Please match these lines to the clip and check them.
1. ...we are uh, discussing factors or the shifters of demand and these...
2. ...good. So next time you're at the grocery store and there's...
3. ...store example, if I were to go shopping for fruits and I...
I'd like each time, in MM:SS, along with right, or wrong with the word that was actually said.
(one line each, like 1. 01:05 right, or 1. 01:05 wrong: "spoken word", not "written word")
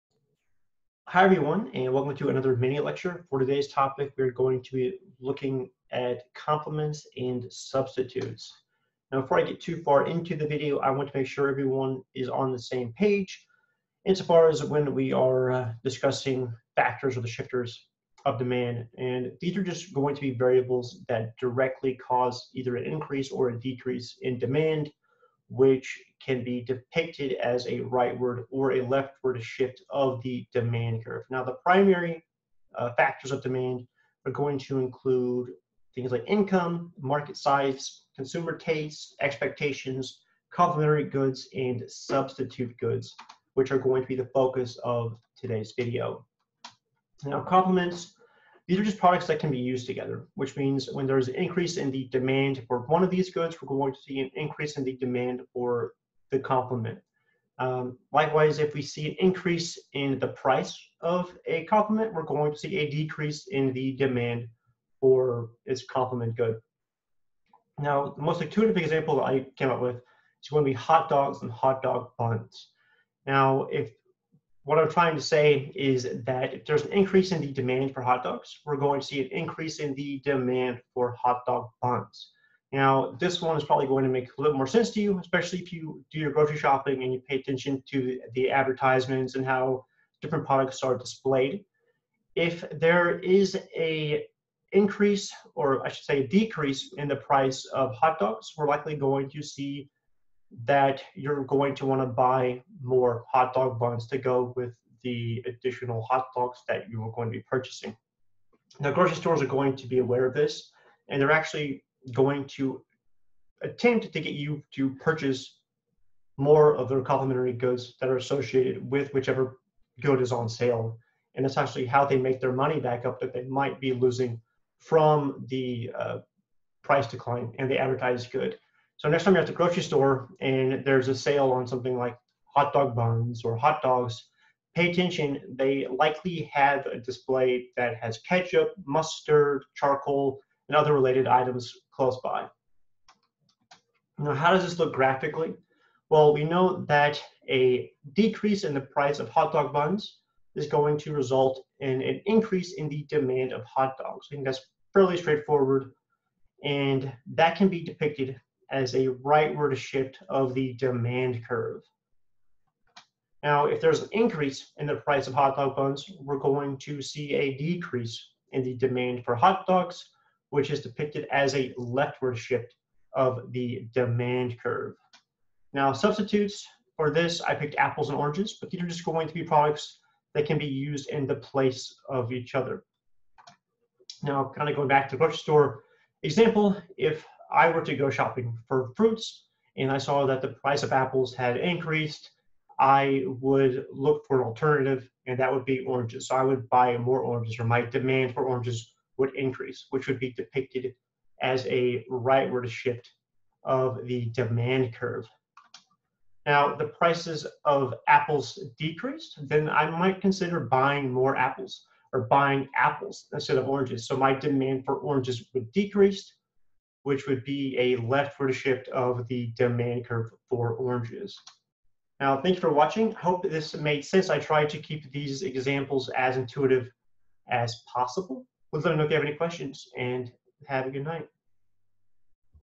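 1. 00:14 right
2. 02:08 right
3. 03:05 right.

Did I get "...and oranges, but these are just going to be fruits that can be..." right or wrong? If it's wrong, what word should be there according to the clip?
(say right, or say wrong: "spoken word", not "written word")
wrong: "products", not "fruits".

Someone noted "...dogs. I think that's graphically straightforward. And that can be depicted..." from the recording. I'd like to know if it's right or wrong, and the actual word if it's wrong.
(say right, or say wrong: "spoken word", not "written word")
wrong: "fairly", not "graphically".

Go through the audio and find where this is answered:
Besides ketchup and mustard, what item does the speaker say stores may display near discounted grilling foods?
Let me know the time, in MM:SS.
02:19.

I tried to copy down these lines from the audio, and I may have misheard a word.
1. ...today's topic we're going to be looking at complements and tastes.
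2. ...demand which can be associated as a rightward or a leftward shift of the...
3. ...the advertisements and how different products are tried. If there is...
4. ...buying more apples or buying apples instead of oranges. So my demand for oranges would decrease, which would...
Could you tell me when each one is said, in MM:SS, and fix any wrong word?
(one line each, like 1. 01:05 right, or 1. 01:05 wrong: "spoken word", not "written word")
1. 00:03 wrong: "substitutes", not "tastes"
2. 00:24 wrong: "depicted", not "associated"
3. 01:28 wrong: "displayed", not "tried"
4. 03:30 right.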